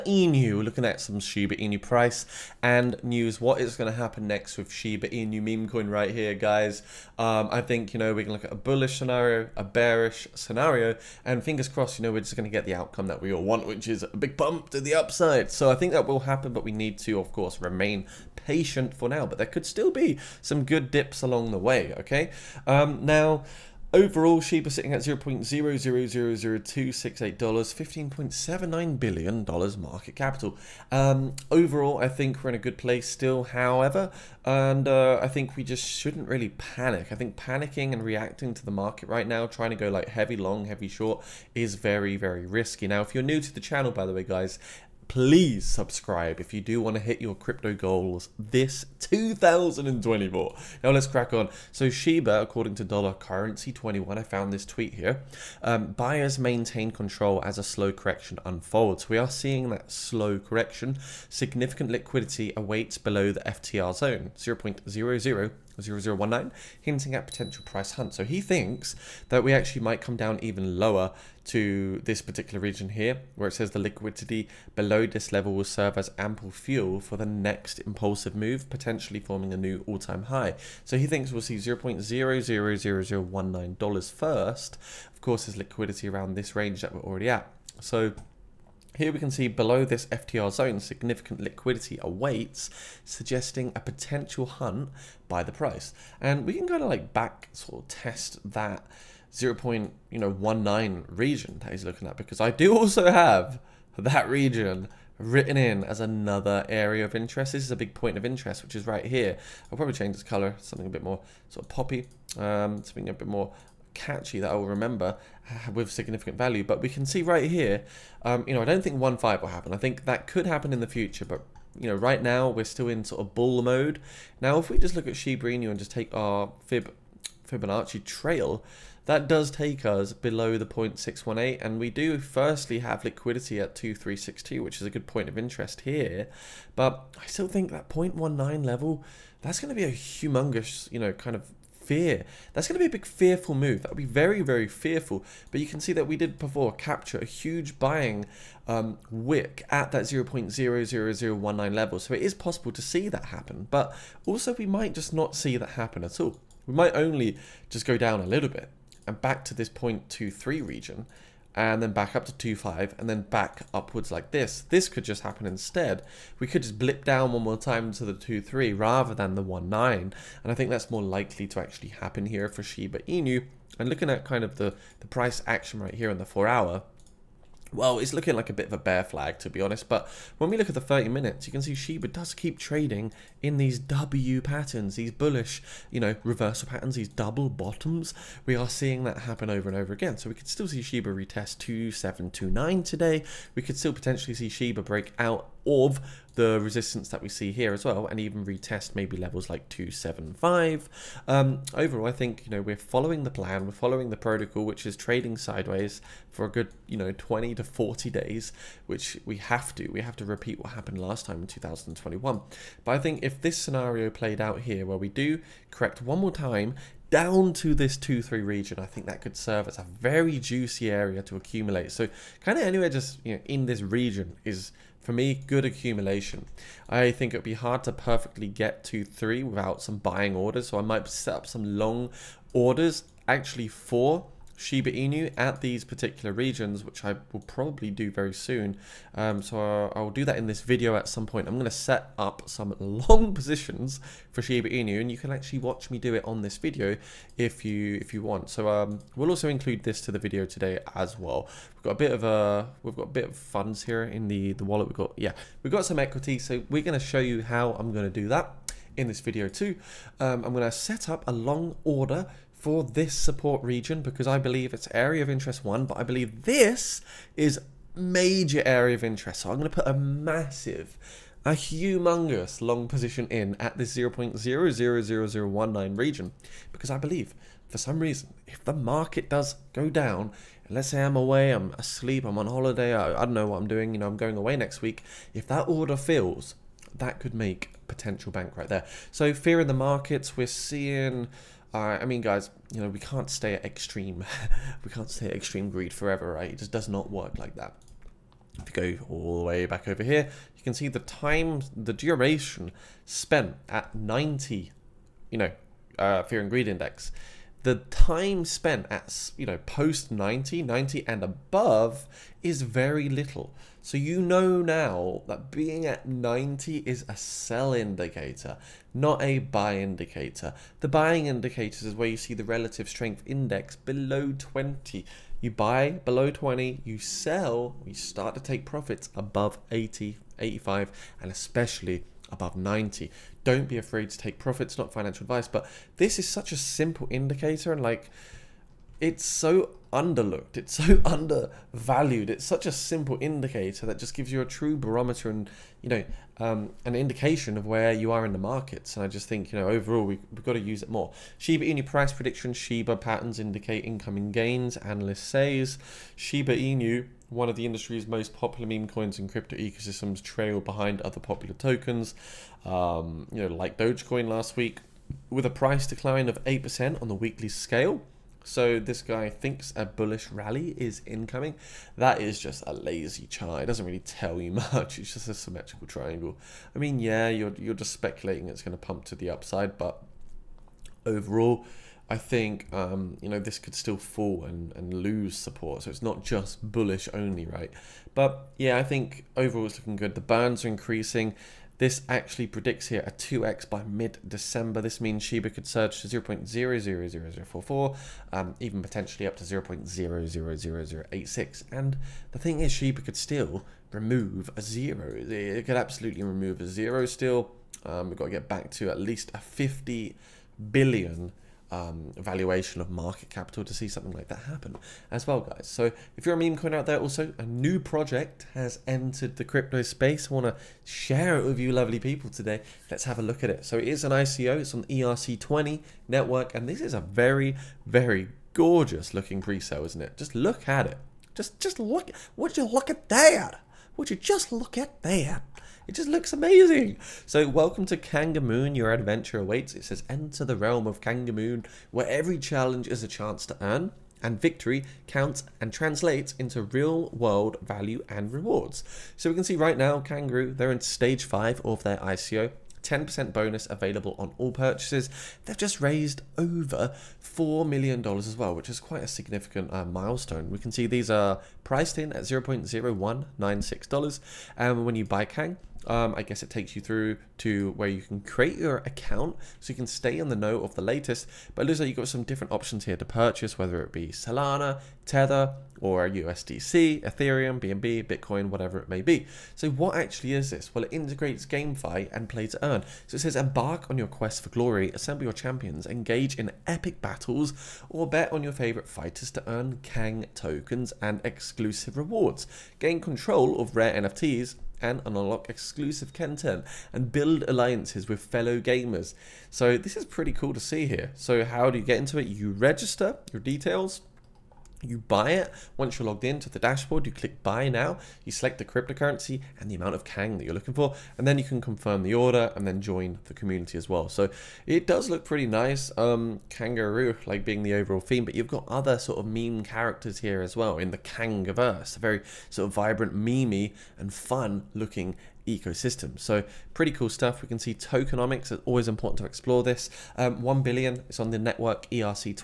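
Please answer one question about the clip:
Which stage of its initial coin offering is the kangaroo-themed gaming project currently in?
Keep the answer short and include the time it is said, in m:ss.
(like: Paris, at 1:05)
stage five, at 7:30.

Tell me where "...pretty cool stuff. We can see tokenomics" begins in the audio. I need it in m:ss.
8:46.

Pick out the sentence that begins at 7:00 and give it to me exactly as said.
I want to share it with you, lovely people, today.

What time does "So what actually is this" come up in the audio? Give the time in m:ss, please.
7:59.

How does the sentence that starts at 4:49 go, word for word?
So fear in the markets, we're seeing uh, I mean, guys, you know, we can't stay at extreme.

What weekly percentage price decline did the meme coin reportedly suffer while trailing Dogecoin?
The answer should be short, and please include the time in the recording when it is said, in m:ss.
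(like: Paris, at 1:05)
8%, at 6:06.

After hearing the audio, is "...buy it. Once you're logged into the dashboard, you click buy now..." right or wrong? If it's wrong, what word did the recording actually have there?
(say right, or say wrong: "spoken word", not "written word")
right.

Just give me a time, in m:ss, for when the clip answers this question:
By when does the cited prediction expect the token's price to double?
6:33.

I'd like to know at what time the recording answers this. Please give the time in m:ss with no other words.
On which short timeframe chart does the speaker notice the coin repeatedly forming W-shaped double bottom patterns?
3:00.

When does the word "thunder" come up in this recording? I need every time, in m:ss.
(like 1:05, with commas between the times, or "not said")
not said.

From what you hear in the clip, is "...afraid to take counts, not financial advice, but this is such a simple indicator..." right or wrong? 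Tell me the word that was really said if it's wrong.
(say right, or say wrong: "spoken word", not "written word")
wrong: "profits", not "counts".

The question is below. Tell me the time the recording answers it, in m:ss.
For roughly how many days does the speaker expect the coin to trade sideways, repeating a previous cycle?
3:27.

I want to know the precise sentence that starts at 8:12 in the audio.
Gain control of rare NFTs and unlock exclusive content and build alliances with fellow gamers.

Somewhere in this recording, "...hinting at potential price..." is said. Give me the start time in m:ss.
1:06.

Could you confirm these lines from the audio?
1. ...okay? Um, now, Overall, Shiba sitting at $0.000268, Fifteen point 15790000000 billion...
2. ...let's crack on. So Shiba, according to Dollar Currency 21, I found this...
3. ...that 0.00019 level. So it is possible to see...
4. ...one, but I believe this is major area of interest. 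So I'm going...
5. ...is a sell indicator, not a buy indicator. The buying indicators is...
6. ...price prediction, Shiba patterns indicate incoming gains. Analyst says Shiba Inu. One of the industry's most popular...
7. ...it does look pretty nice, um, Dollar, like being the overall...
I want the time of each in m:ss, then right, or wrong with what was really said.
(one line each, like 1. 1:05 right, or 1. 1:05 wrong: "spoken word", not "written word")
1. 0:21 right
2. 0:50 right
3. 2:29 right
4. 4:25 right
5. 5:16 right
6. 5:51 right
7. 8:34 wrong: "Kangaroo", not "Dollar".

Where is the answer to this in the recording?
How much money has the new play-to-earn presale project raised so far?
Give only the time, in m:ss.
7:36.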